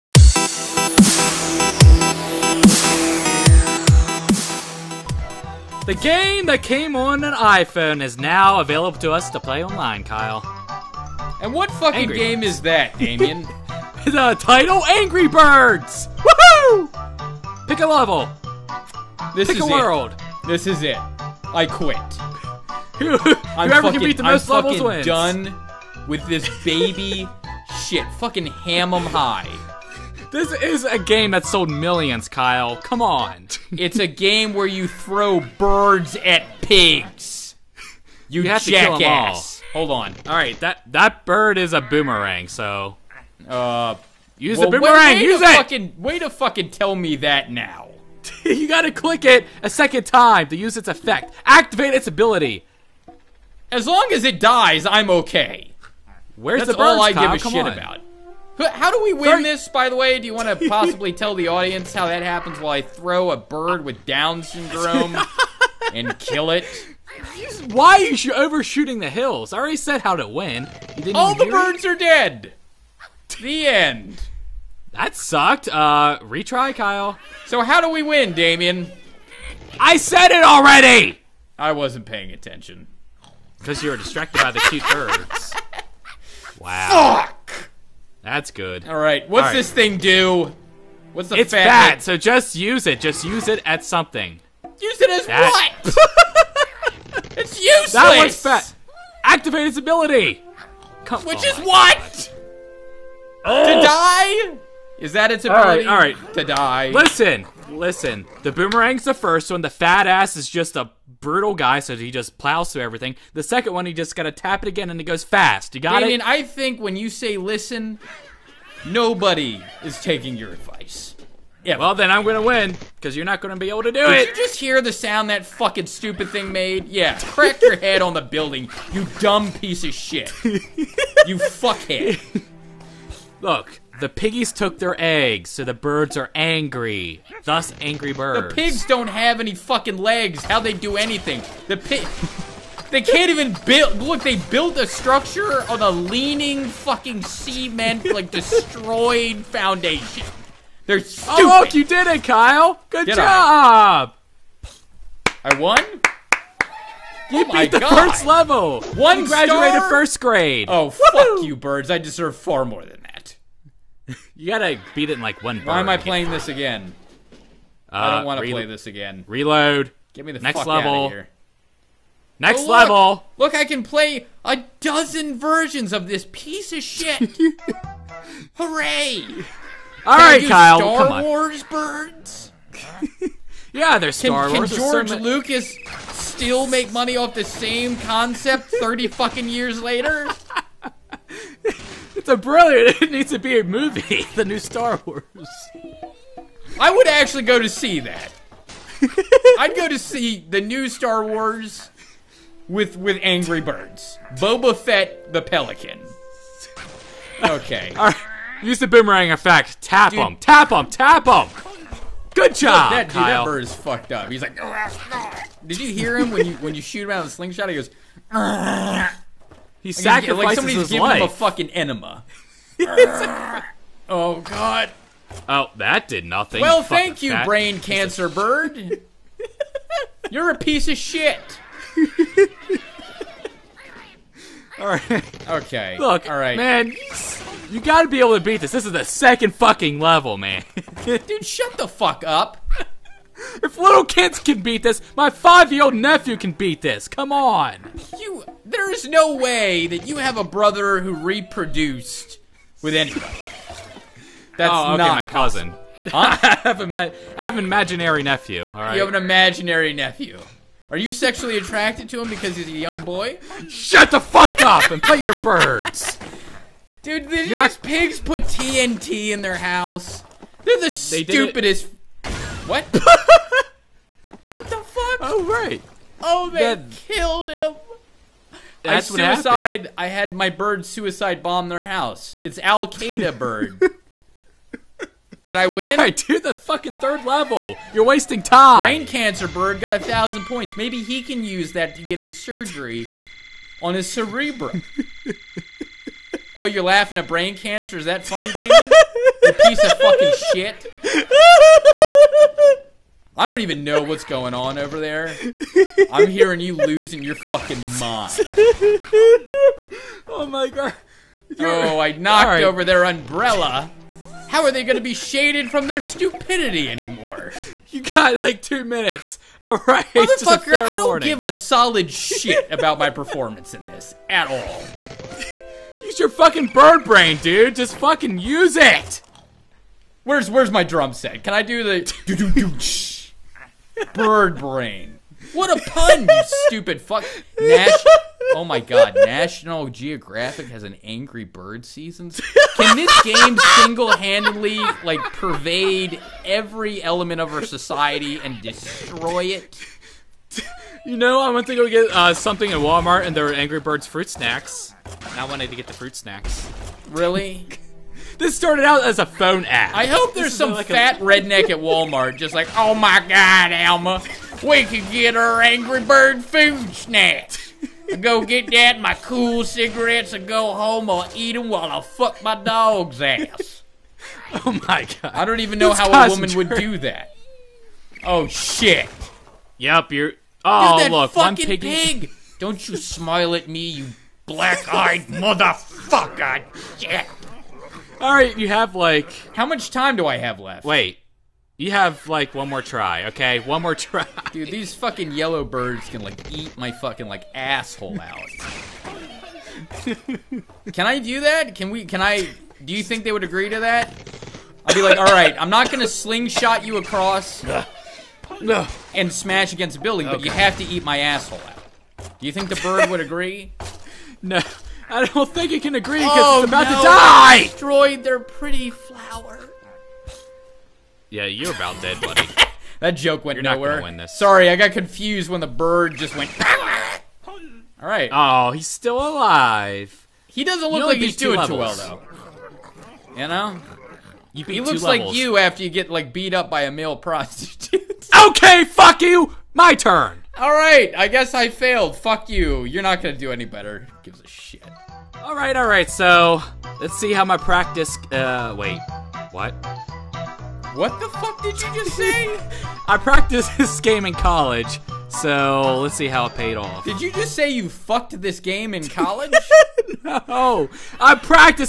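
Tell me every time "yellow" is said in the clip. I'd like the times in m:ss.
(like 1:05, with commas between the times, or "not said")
6:35.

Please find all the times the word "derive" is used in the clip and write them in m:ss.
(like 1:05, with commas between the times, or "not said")
not said.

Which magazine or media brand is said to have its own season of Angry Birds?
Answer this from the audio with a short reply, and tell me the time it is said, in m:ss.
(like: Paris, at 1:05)
National Geographic, at 5:39.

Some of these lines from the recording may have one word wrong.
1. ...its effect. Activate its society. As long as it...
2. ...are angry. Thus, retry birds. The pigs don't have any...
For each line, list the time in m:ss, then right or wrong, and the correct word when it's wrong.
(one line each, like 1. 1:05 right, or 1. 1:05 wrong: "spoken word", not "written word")
1. 0:50 wrong: "ability", not "society"
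2. 2:16 wrong: "angry", not "retry".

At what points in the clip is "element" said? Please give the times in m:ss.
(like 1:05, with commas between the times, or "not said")
5:47.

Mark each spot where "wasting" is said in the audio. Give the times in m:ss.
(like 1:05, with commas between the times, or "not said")
4:48.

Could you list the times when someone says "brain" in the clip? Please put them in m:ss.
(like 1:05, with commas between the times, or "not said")
3:47, 4:48, 4:57, 5:27, 5:34.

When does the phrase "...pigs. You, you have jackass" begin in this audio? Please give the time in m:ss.
0:36.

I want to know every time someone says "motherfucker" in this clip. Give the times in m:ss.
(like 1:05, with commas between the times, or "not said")
5:20, 6:25.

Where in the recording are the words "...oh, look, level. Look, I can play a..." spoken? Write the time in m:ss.
2:52.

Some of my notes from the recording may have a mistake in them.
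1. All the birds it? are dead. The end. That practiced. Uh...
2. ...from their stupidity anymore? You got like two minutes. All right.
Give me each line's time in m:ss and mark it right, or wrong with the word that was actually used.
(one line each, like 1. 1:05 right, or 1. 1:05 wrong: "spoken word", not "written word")
1. 1:11 wrong: "sucked", not "practiced"
2. 5:15 right.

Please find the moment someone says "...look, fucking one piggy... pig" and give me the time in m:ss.
6:21.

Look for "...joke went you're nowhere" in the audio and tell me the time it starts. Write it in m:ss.
7:03.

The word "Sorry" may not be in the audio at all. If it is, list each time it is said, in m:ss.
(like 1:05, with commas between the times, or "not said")
0:59, 7:04.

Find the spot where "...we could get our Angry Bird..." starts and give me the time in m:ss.
6:04.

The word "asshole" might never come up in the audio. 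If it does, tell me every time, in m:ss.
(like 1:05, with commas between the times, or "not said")
6:37, 6:51.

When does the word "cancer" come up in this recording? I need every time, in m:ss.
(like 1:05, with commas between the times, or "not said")
3:47, 4:49, 4:57.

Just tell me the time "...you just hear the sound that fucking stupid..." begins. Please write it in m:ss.
2:04.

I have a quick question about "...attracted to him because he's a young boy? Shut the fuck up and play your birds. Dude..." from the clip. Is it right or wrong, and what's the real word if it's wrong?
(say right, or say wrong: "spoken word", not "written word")
right.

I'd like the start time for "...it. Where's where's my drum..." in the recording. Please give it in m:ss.
5:28.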